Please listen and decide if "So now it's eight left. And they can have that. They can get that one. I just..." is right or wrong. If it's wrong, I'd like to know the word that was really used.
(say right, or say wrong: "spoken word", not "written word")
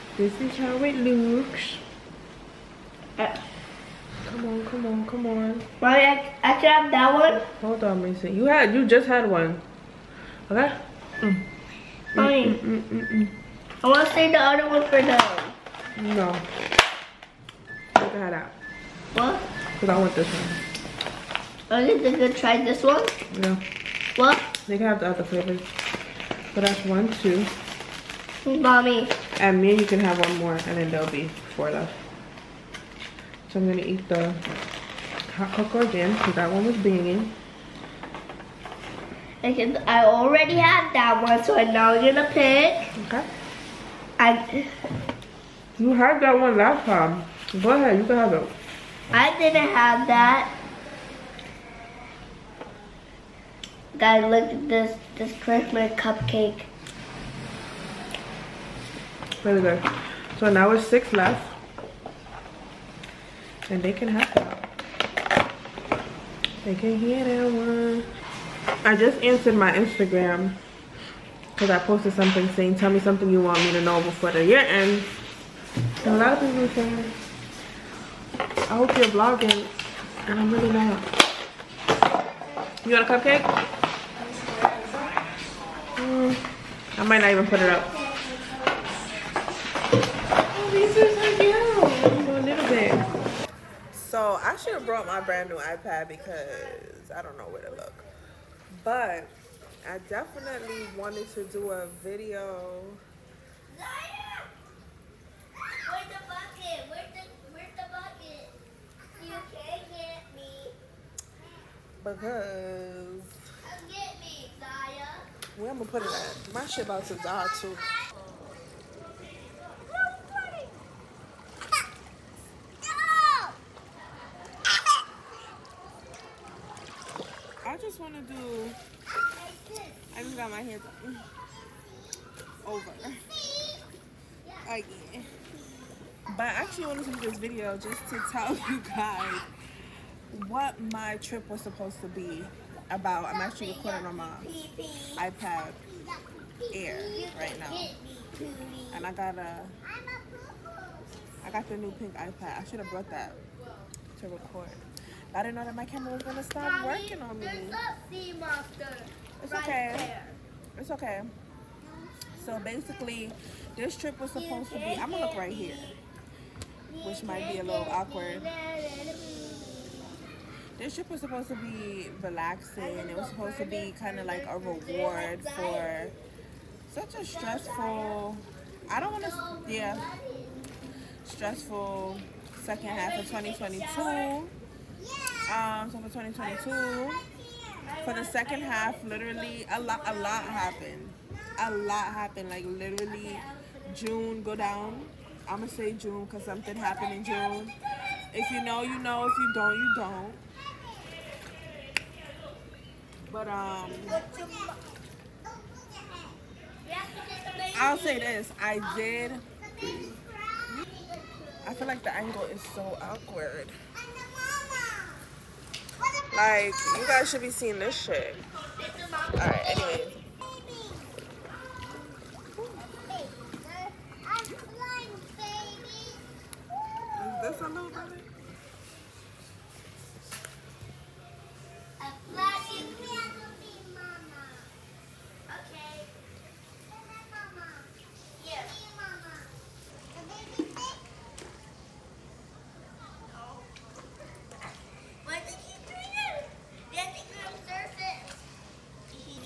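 wrong: "six", not "eight".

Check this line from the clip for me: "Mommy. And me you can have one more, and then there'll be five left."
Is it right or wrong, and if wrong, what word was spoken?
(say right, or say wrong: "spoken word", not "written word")
wrong: "four", not "five".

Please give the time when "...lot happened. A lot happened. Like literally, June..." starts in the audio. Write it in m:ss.
3:10.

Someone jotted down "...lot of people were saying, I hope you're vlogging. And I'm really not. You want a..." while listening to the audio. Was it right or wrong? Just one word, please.
right.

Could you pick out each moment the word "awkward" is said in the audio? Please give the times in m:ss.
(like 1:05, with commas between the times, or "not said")
2:47, 3:32.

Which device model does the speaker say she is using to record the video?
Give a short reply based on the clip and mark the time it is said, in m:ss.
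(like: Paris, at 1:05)
iPad Air, at 2:25.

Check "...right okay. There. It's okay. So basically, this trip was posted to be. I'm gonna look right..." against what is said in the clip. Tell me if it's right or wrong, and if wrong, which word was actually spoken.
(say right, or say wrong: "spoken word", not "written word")
wrong: "supposed", not "posted".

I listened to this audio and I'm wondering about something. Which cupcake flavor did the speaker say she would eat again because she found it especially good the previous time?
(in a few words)
Hot cocoa.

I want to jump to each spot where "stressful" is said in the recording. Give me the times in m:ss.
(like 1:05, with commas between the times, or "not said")
2:57, 3:01.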